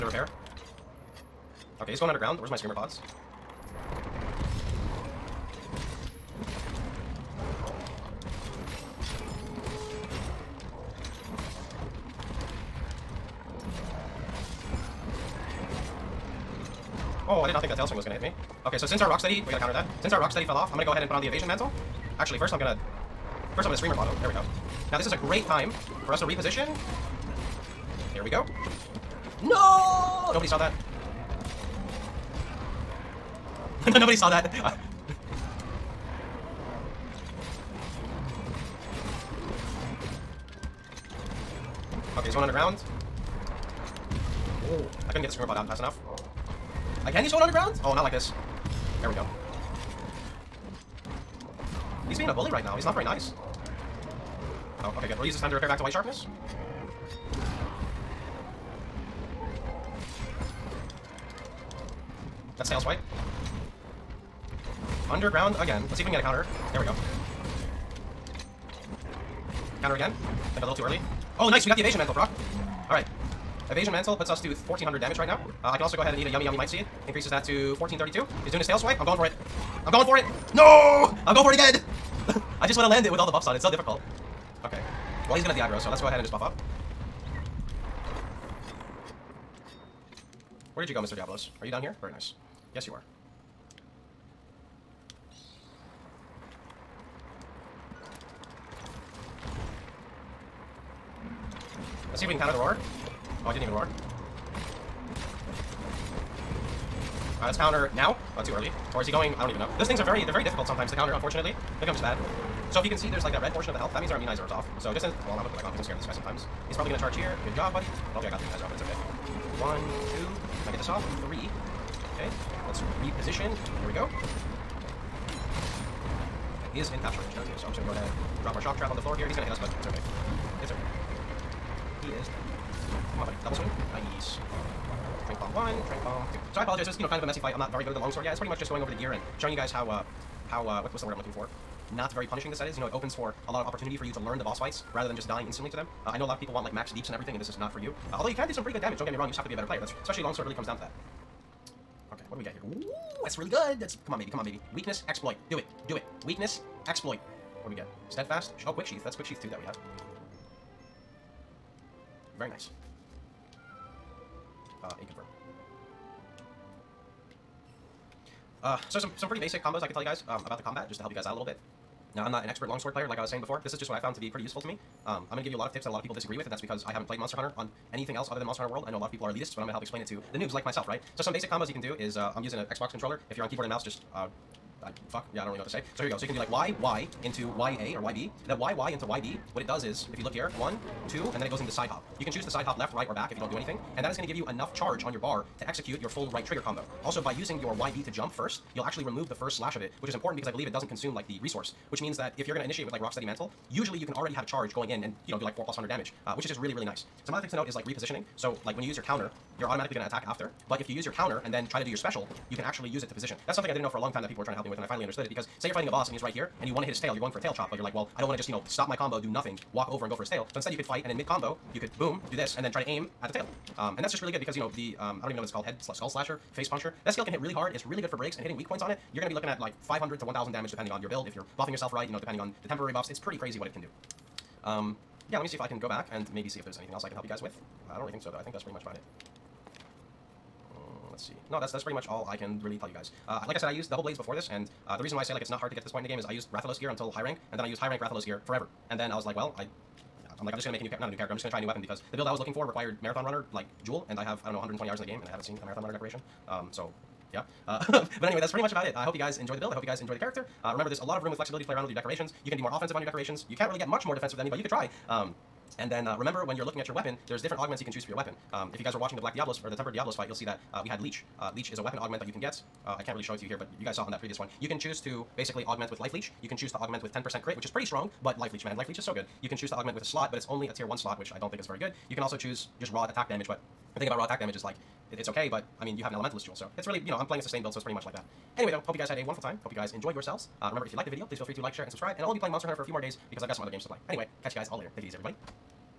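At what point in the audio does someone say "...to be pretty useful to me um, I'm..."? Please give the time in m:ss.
2:54.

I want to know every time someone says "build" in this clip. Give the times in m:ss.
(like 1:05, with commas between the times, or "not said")
3:51, 4:12, 4:19, 4:47.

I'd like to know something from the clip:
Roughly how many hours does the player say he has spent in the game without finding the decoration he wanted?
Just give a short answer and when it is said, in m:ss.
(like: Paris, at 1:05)
120, at 4:14.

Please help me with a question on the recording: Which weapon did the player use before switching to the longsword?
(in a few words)
double blades.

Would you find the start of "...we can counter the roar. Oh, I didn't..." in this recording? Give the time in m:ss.
1:42.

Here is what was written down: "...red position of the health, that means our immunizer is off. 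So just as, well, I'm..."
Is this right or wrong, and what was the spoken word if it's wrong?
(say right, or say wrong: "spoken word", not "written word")
wrong: "portion", not "position".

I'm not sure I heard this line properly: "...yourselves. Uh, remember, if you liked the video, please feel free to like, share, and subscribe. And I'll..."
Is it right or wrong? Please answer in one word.
right.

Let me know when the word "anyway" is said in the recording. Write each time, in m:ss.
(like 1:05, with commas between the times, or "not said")
4:18, 4:48, 4:54.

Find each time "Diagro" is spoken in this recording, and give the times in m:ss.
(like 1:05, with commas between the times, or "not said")
1:25.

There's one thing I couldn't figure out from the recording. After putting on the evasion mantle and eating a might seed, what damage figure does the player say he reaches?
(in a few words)
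1432.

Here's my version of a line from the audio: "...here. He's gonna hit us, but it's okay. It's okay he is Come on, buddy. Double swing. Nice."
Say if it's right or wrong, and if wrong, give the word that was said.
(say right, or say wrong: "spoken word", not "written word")
right.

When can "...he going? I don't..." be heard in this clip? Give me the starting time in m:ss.
1:49.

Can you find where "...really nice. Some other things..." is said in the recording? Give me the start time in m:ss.
3:26.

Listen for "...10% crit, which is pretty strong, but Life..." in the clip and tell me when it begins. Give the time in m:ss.
4:37.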